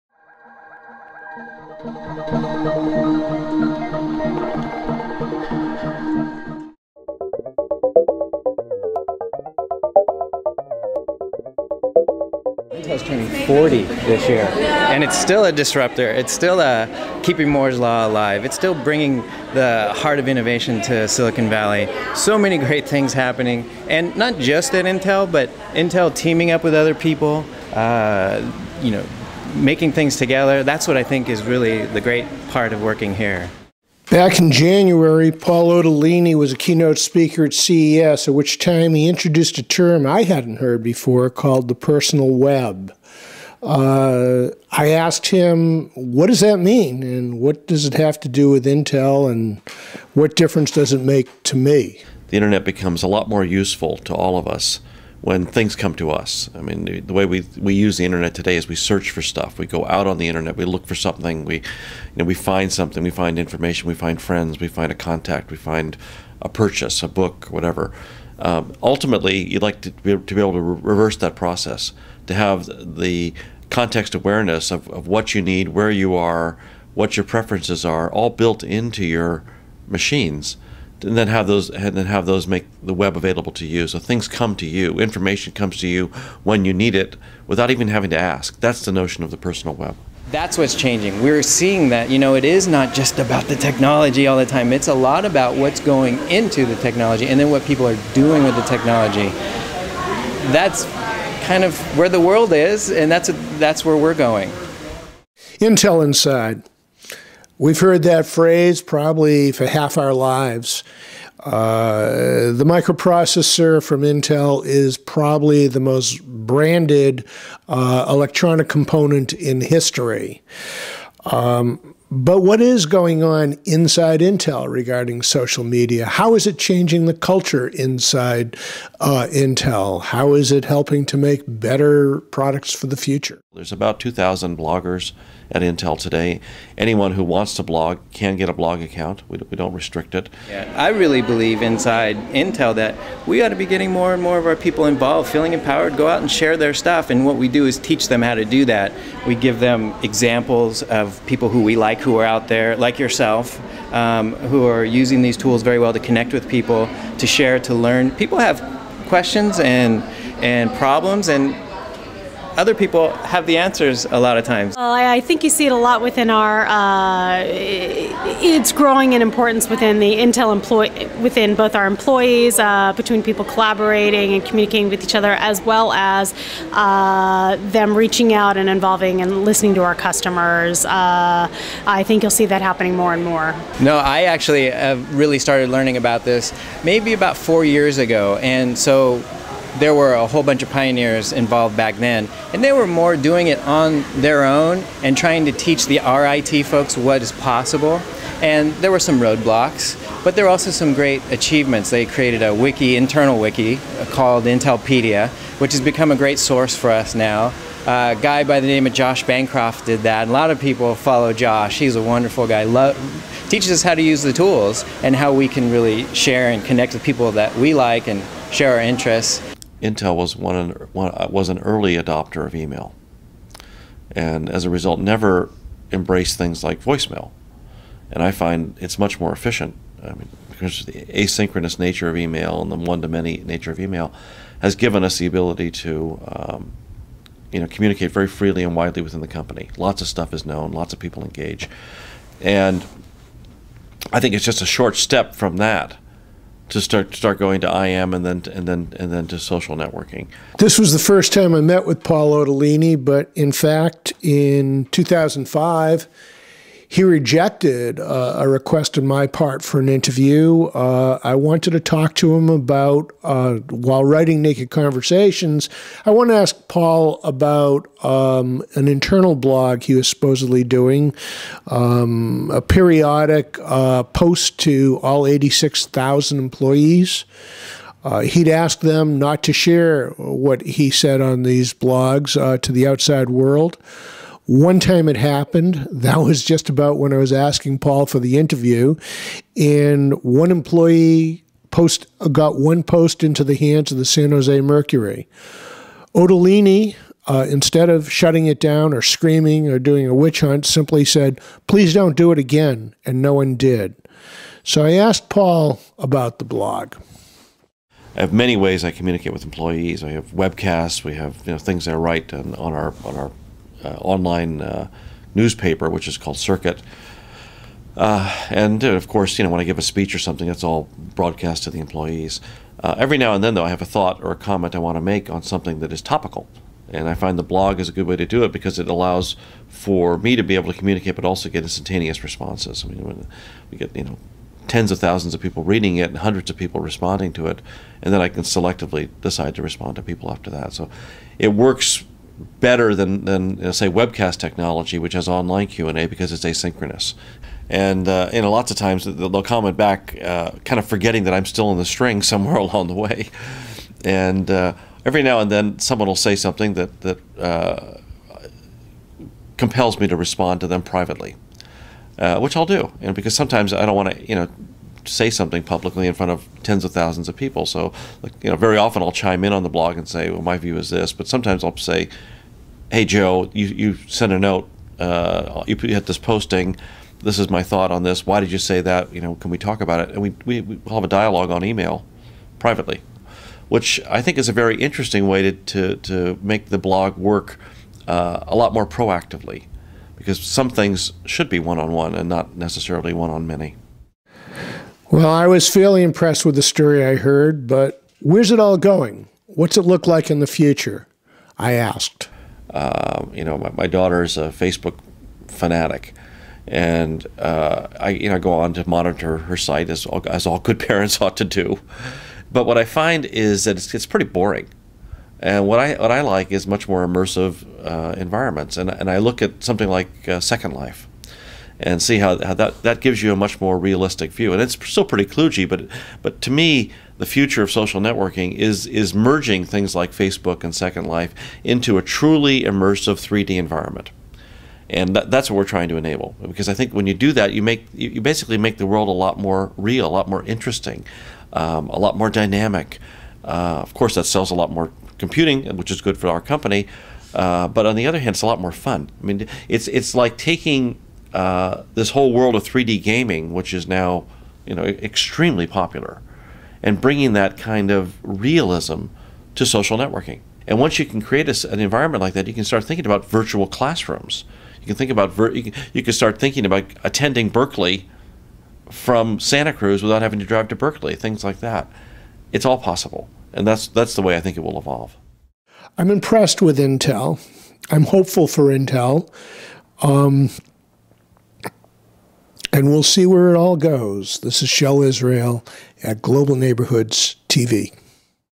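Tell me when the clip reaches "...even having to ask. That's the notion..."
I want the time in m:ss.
1:27.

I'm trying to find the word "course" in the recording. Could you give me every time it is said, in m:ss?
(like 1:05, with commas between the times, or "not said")
5:19, 7:23.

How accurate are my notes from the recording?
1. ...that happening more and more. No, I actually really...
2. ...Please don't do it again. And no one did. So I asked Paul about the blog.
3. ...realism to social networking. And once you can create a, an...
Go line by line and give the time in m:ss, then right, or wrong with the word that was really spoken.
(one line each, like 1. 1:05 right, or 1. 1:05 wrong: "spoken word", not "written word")
1. 3:02 right
2. 5:01 right
3. 7:38 right.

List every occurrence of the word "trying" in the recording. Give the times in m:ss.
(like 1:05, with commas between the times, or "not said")
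3:15, 7:15.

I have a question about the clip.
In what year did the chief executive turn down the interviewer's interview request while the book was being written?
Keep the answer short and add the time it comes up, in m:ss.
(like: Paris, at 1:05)
2005, at 4:14.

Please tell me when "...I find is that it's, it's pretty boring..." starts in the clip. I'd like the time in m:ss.
6:52.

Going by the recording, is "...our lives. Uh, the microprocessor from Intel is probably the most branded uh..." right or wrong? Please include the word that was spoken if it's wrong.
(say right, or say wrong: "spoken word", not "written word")
right.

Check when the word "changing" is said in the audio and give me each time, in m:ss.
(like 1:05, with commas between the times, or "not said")
1:30, 2:06.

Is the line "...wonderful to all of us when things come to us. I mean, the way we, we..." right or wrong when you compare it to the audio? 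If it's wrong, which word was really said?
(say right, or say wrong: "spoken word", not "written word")
wrong: "useful", not "wonderful".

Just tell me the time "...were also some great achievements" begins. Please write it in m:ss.
3:20.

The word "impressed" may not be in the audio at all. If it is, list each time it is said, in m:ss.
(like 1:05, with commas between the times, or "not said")
6:36, 7:56.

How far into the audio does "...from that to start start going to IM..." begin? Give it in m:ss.
4:05.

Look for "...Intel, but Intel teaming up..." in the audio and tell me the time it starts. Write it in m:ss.
0:24.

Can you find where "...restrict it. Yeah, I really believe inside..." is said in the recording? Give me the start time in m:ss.
2:19.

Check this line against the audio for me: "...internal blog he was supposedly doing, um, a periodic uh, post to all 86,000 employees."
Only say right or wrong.
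right.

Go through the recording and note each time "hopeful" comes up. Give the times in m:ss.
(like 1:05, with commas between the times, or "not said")
7:58.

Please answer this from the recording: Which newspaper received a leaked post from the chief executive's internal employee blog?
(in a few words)
San Jose Mercury.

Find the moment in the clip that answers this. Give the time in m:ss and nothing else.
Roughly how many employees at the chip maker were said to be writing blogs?
2:13.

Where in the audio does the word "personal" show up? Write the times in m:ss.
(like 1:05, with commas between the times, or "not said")
0:41, 1:29.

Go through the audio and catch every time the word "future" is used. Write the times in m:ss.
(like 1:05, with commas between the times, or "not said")
2:12, 6:40, 7:07.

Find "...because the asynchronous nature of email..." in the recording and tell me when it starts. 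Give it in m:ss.
3:50.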